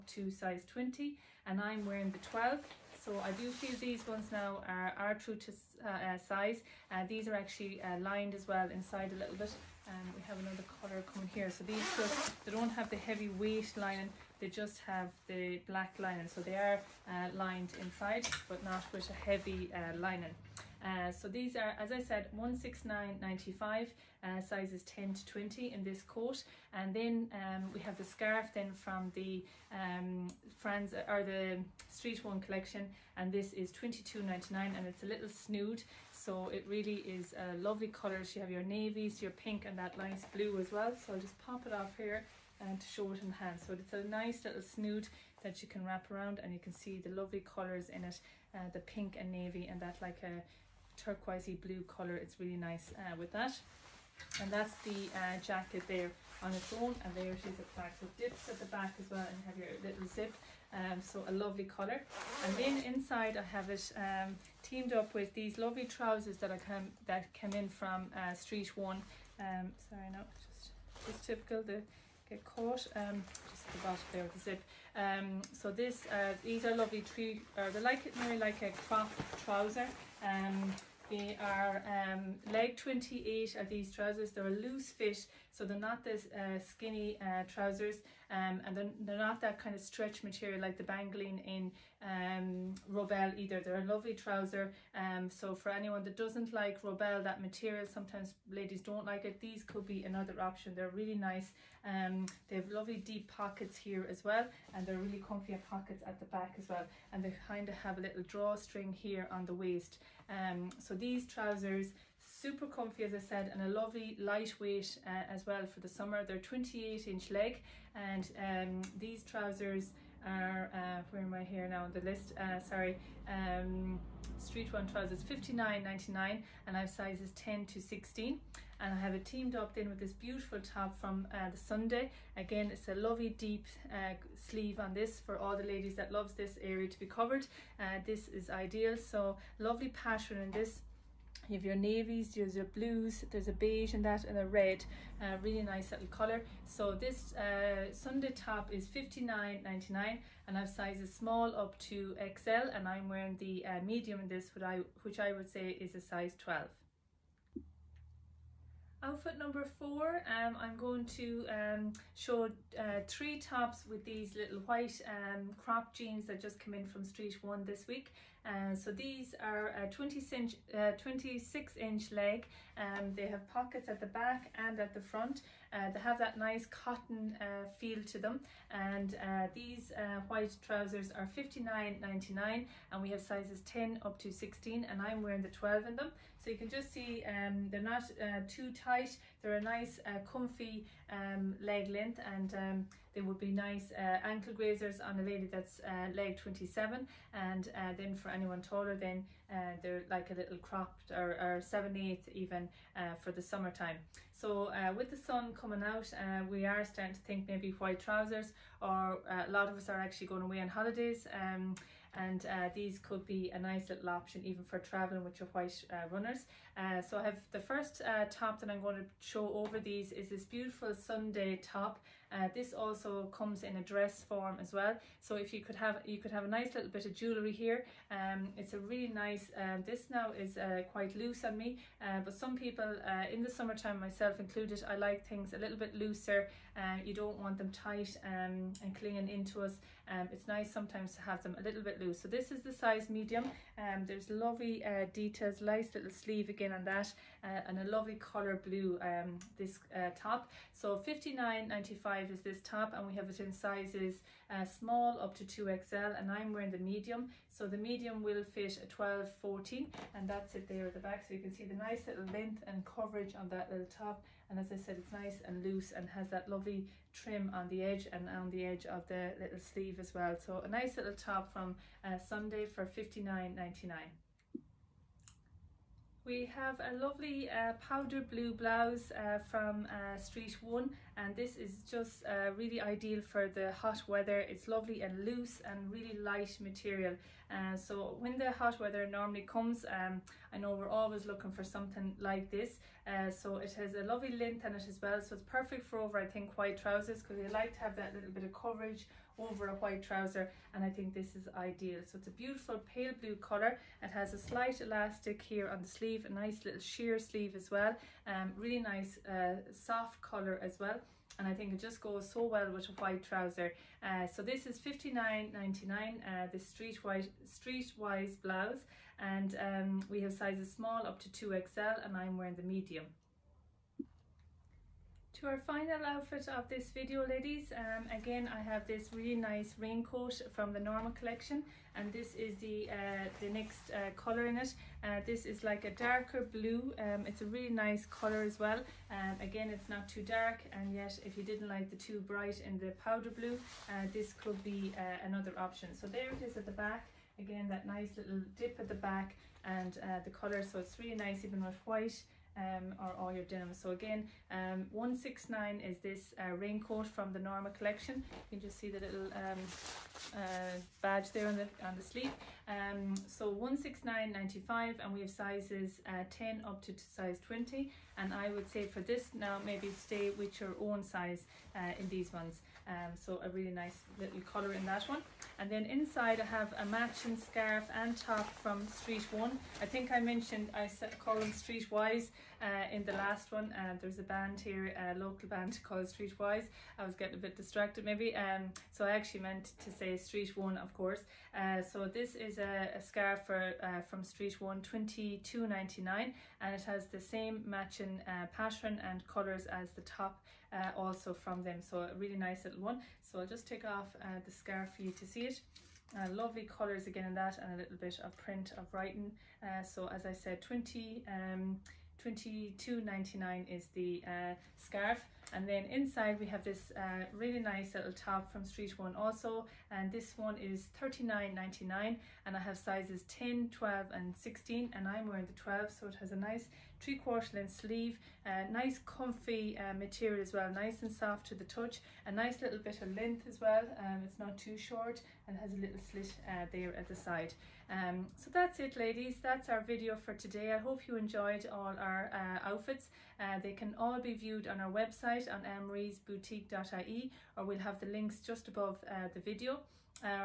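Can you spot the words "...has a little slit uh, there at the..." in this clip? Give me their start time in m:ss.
7:15.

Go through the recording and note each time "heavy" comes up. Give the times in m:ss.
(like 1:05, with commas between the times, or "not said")
0:12, 0:19.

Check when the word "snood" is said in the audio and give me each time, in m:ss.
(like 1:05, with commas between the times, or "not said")
0:35, 0:44.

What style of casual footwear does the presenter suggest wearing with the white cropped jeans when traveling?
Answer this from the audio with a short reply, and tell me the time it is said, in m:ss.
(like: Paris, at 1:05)
white runners, at 3:35.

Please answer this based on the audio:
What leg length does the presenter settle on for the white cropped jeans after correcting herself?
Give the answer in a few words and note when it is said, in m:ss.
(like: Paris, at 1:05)
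26 inch, at 2:51.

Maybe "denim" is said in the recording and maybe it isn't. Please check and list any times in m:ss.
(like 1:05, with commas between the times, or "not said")
5:53.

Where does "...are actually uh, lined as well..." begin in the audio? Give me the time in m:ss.
0:07.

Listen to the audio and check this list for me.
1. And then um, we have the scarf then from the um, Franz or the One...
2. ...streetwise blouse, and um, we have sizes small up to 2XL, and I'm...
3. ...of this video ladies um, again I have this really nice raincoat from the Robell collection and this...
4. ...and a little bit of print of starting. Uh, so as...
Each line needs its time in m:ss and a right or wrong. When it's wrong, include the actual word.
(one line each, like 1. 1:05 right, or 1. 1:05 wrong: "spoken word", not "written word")
1. 0:26 wrong: "Street", not "One"
2. 5:17 right
3. 5:26 wrong: "Norma", not "Robell"
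4. 6:47 wrong: "writing", not "starting".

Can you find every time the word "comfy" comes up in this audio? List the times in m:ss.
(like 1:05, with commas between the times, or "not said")
1:45, 1:52, 3:10, 7:09.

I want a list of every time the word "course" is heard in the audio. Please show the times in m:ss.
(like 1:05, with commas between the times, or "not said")
6:30.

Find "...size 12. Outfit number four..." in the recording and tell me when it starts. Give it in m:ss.
2:36.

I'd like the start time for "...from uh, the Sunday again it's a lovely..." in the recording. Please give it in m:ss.
2:10.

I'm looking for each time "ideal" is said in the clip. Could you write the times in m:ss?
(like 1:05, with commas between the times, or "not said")
2:18, 4:42, 5:01.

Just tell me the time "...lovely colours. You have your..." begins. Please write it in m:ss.
0:37.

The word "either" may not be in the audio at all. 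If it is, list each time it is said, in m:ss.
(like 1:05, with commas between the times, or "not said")
1:33.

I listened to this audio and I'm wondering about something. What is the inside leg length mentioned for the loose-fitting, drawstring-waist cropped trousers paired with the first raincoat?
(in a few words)
28 inch.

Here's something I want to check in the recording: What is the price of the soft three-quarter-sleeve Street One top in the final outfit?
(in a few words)
39.99.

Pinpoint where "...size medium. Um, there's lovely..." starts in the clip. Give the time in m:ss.
4:02.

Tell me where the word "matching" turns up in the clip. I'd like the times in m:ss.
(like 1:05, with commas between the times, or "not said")
6:16, 6:37.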